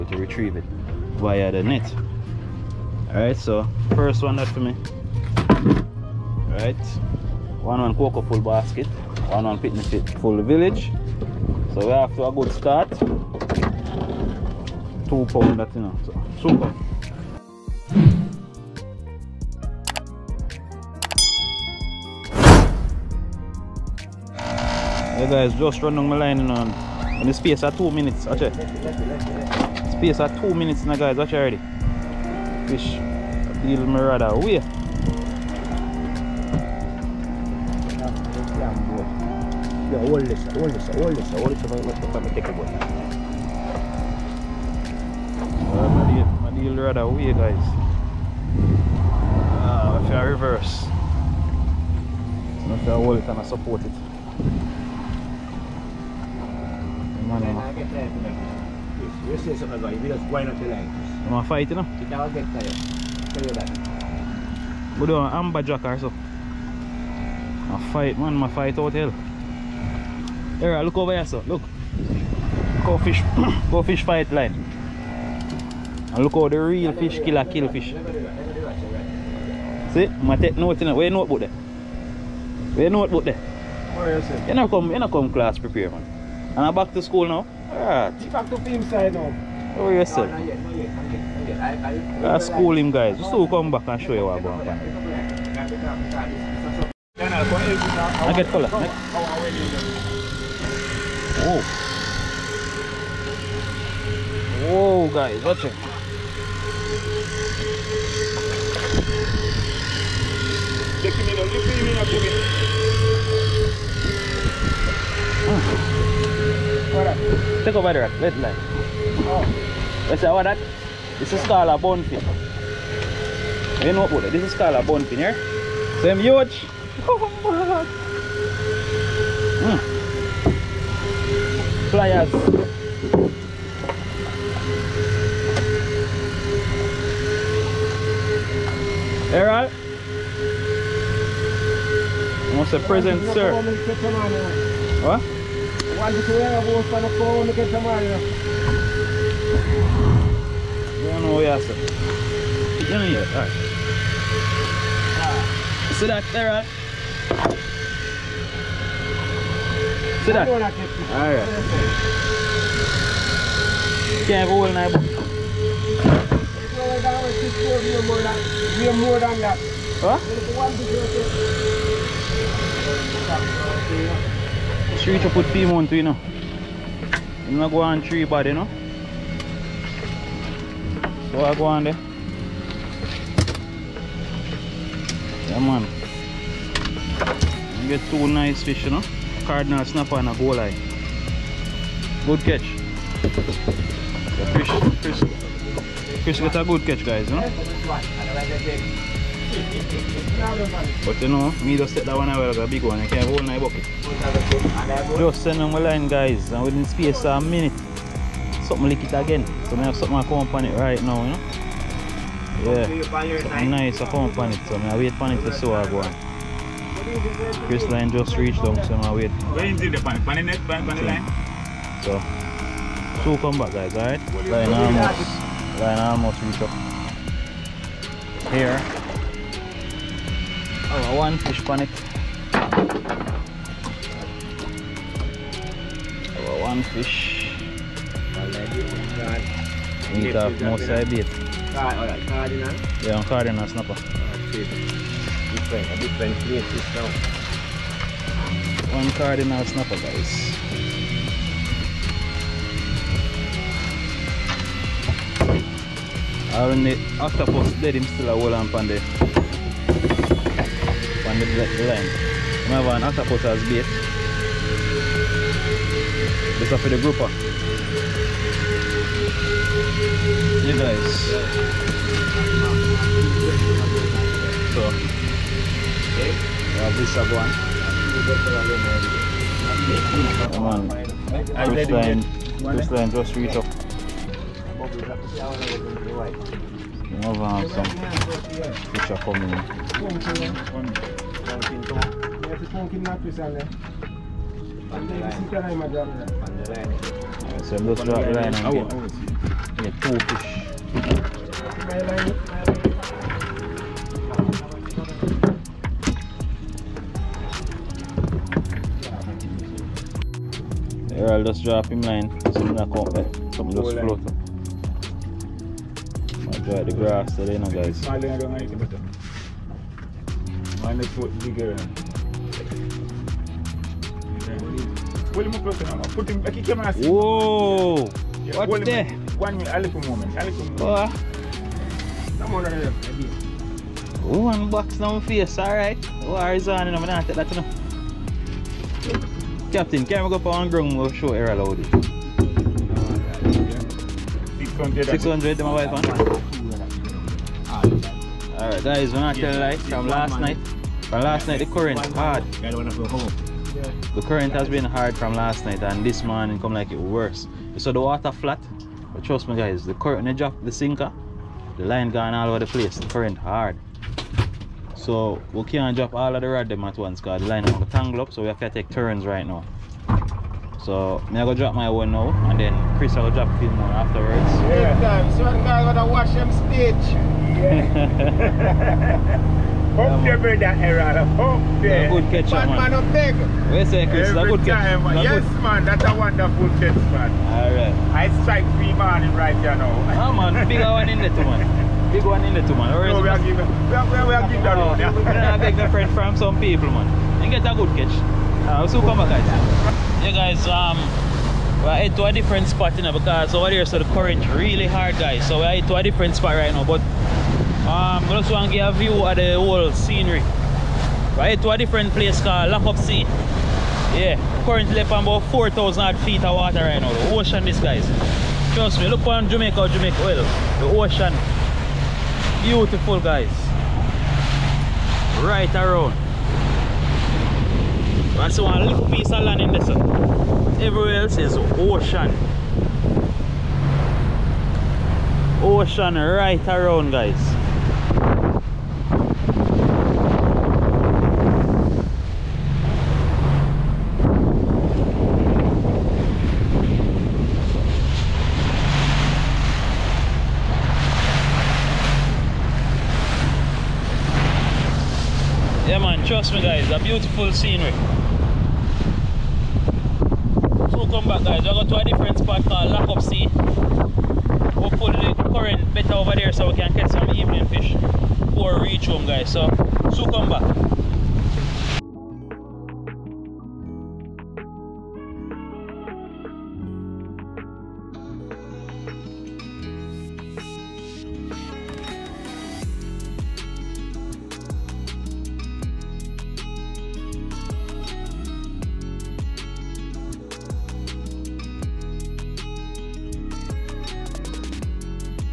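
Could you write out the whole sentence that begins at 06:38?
Uh, ah, so come back, guys.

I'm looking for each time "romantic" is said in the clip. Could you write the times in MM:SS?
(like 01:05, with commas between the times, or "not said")
not said.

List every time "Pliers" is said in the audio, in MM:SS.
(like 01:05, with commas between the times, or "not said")
02:11.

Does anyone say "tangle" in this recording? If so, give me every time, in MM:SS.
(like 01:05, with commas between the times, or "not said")
06:07.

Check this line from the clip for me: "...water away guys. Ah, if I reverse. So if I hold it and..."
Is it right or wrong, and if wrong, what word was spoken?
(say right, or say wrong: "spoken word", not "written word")
wrong: "rather", not "water".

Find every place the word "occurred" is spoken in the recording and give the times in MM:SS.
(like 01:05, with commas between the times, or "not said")
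not said.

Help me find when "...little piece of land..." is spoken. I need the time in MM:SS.
07:08.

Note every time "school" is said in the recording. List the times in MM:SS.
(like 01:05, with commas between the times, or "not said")
01:27.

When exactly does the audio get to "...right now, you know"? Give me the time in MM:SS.
03:30.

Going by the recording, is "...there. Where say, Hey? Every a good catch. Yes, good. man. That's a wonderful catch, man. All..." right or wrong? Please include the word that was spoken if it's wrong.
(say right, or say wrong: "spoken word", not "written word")
wrong: "Chris", not "Hey".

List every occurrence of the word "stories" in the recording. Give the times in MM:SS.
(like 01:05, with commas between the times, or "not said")
not said.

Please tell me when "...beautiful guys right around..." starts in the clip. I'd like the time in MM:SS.
07:02.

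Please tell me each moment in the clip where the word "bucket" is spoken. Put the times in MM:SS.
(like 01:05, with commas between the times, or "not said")
03:23.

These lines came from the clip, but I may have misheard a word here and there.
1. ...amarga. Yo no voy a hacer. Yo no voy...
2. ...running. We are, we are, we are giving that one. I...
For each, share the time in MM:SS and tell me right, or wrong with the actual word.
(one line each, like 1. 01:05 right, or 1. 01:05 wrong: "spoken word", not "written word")
1. 02:27 right
2. 06:33 wrong: "giving", not "running".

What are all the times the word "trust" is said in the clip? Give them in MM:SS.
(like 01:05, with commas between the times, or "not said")
05:59, 06:58.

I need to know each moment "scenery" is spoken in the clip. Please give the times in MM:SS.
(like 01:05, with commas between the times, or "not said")
06:49, 07:37.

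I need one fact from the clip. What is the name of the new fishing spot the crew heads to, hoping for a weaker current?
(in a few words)
Lockup Sea.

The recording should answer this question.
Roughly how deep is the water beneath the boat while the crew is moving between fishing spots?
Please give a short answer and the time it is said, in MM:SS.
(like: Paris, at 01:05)
4,000 feet, at 06:55.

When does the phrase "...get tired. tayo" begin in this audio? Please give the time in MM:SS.
01:02.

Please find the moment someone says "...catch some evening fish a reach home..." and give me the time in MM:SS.
07:46.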